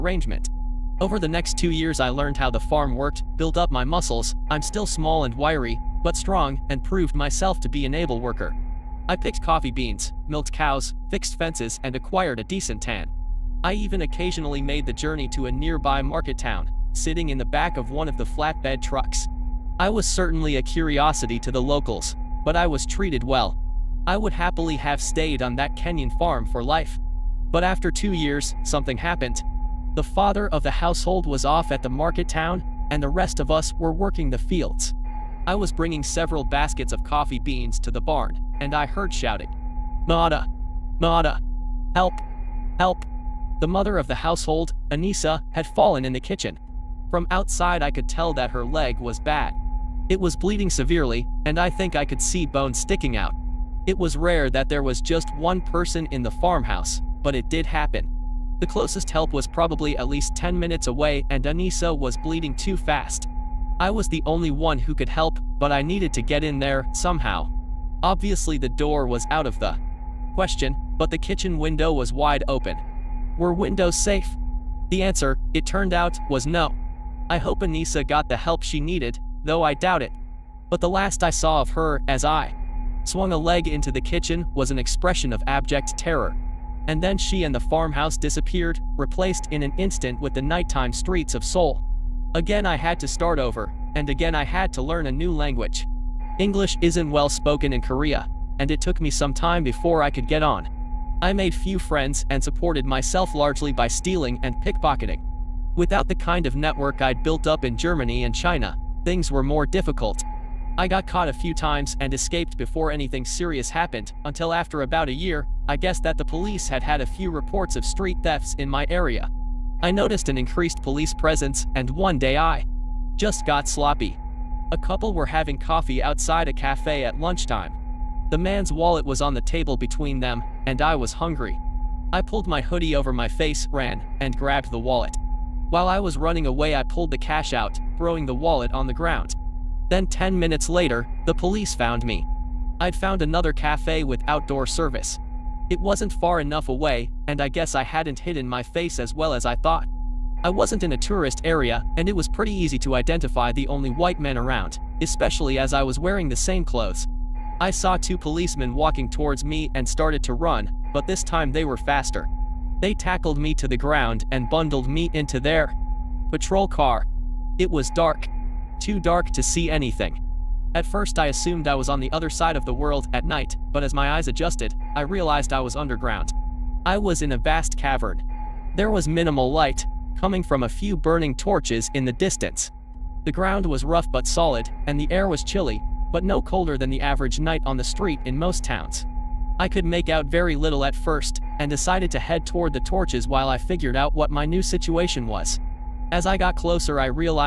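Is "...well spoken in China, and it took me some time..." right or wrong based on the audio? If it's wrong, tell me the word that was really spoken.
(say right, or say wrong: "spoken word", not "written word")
wrong: "Korea", not "China".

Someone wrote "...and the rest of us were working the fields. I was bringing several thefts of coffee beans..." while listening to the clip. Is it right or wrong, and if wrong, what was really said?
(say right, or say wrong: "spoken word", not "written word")
wrong: "baskets", not "thefts".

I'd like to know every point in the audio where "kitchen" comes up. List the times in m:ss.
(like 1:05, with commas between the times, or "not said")
0:46, 1:11, 1:24.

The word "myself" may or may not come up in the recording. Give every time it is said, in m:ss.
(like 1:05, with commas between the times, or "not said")
0:07, 1:42.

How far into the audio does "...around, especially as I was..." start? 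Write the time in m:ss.
2:34.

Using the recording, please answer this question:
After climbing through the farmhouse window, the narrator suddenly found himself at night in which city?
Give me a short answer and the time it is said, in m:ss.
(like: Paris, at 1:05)
Seoul, at 1:31.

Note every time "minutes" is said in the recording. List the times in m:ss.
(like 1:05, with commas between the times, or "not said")
1:00, 2:20.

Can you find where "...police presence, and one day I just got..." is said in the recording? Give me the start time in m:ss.
2:00.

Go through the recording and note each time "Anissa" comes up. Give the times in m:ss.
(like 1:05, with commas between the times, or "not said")
0:44, 1:01, 1:17.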